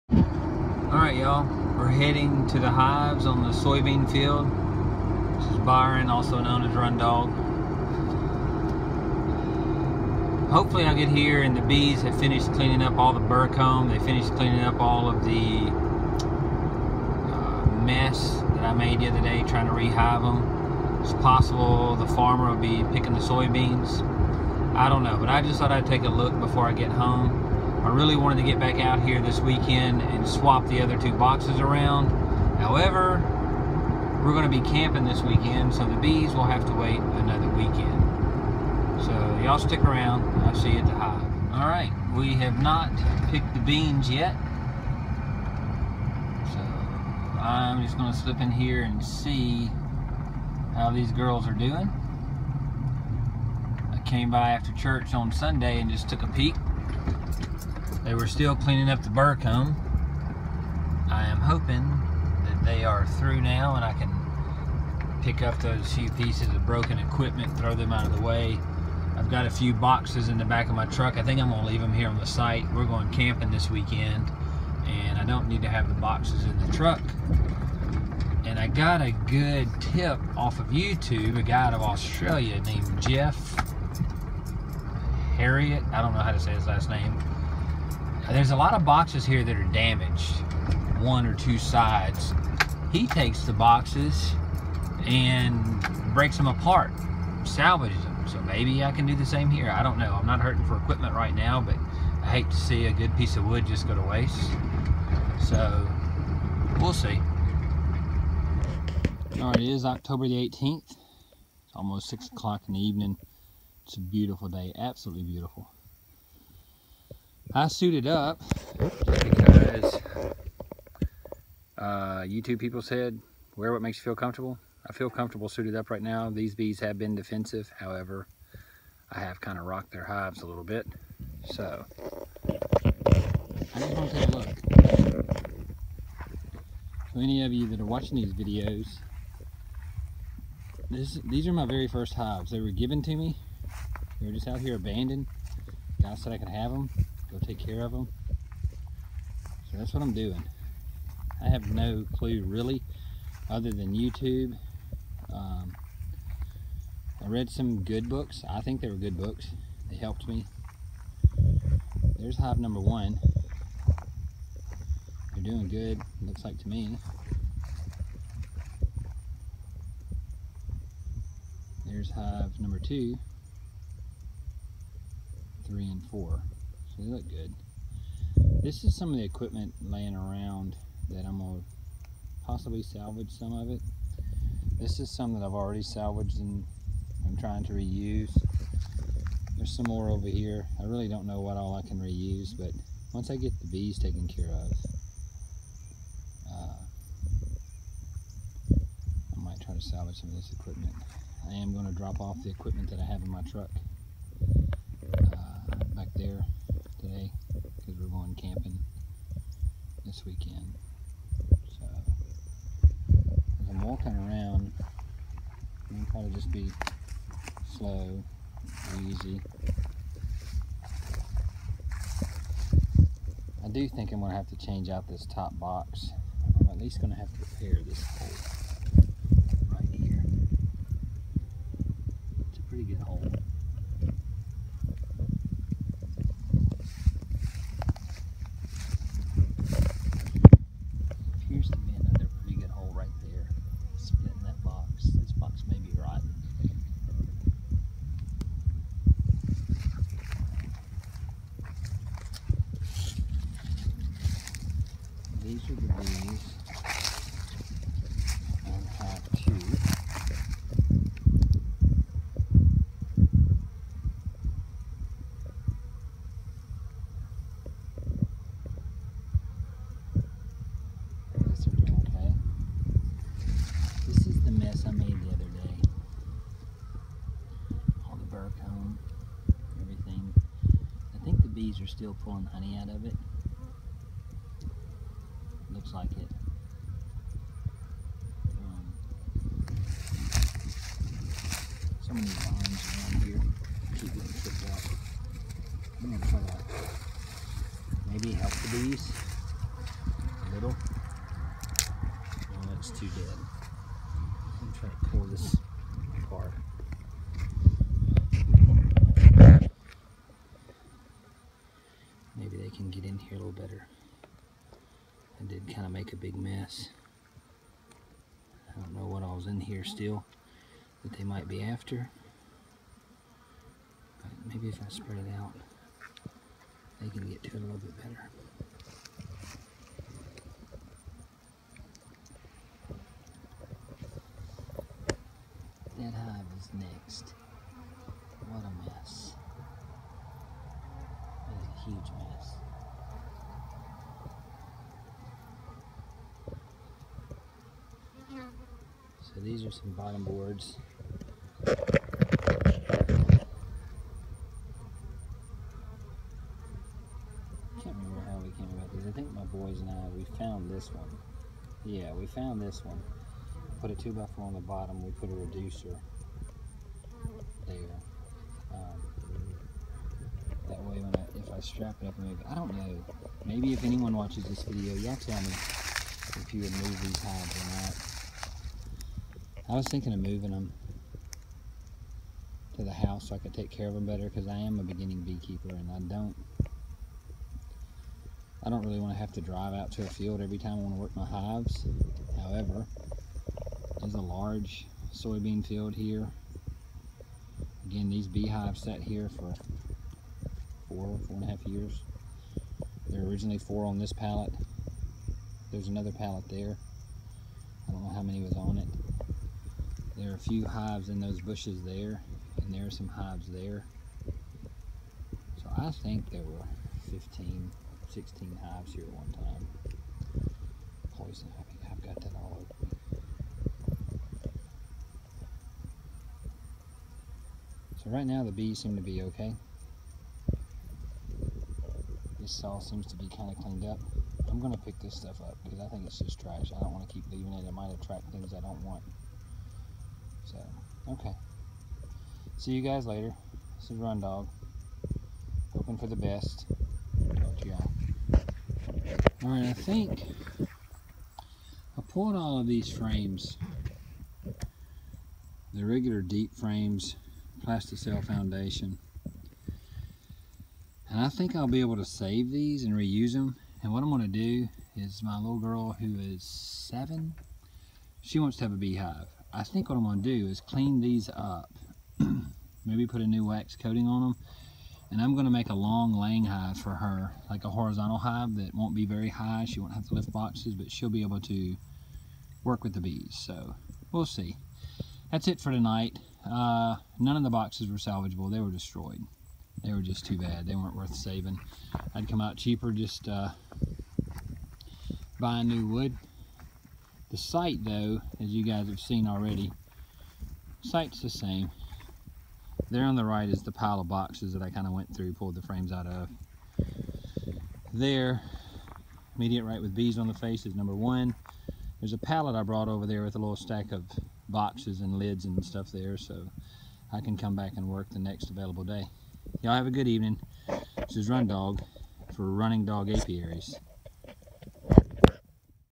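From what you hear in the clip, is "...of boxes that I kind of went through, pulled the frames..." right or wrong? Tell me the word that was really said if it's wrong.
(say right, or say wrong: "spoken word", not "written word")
right.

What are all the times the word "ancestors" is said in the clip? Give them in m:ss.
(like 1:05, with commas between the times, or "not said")
not said.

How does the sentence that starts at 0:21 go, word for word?
It's possible the farmer will be picking the soybeans.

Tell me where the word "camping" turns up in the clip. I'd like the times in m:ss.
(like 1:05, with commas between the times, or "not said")
0:34, 1:13, 3:28.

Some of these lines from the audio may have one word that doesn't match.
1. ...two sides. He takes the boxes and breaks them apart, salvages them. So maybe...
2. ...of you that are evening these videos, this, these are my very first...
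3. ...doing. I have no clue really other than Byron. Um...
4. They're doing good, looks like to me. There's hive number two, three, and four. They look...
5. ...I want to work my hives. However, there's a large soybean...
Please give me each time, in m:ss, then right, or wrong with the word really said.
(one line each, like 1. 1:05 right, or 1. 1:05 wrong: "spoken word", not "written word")
1. 1:31 right
2. 2:17 wrong: "watching", not "evening"
3. 2:30 wrong: "YouTube", not "Byron"
4. 2:45 right
5. 6:30 right.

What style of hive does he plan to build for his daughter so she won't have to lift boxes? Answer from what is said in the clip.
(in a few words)
Horizontal hive.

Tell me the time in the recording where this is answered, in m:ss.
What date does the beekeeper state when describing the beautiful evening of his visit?
1:49.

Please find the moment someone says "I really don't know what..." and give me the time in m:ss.
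3:10.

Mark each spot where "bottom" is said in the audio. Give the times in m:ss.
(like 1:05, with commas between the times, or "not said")
5:49, 6:04.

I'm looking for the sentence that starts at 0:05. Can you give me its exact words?
This is Byron, also known as Run Dog.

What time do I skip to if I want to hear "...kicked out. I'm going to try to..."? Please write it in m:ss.
4:54.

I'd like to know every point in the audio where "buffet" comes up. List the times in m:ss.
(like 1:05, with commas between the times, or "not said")
not said.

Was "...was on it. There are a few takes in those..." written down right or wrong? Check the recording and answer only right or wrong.
wrong.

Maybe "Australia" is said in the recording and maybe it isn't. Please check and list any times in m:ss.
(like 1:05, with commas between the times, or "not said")
1:21.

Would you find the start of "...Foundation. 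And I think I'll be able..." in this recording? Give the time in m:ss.
7:38.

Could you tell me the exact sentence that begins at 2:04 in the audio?
I feel comfortable suited up right now.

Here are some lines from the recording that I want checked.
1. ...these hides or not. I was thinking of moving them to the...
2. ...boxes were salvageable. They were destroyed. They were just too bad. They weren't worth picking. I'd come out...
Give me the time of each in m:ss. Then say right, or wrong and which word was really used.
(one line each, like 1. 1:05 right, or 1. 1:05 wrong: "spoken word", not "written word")
1. 6:17 right
2. 8:07 wrong: "saving", not "picking".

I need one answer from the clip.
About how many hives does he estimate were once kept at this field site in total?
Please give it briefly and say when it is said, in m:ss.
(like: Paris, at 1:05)
15 or 16, at 6:57.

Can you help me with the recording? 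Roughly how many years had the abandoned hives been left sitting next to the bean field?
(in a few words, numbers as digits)
4 and a half.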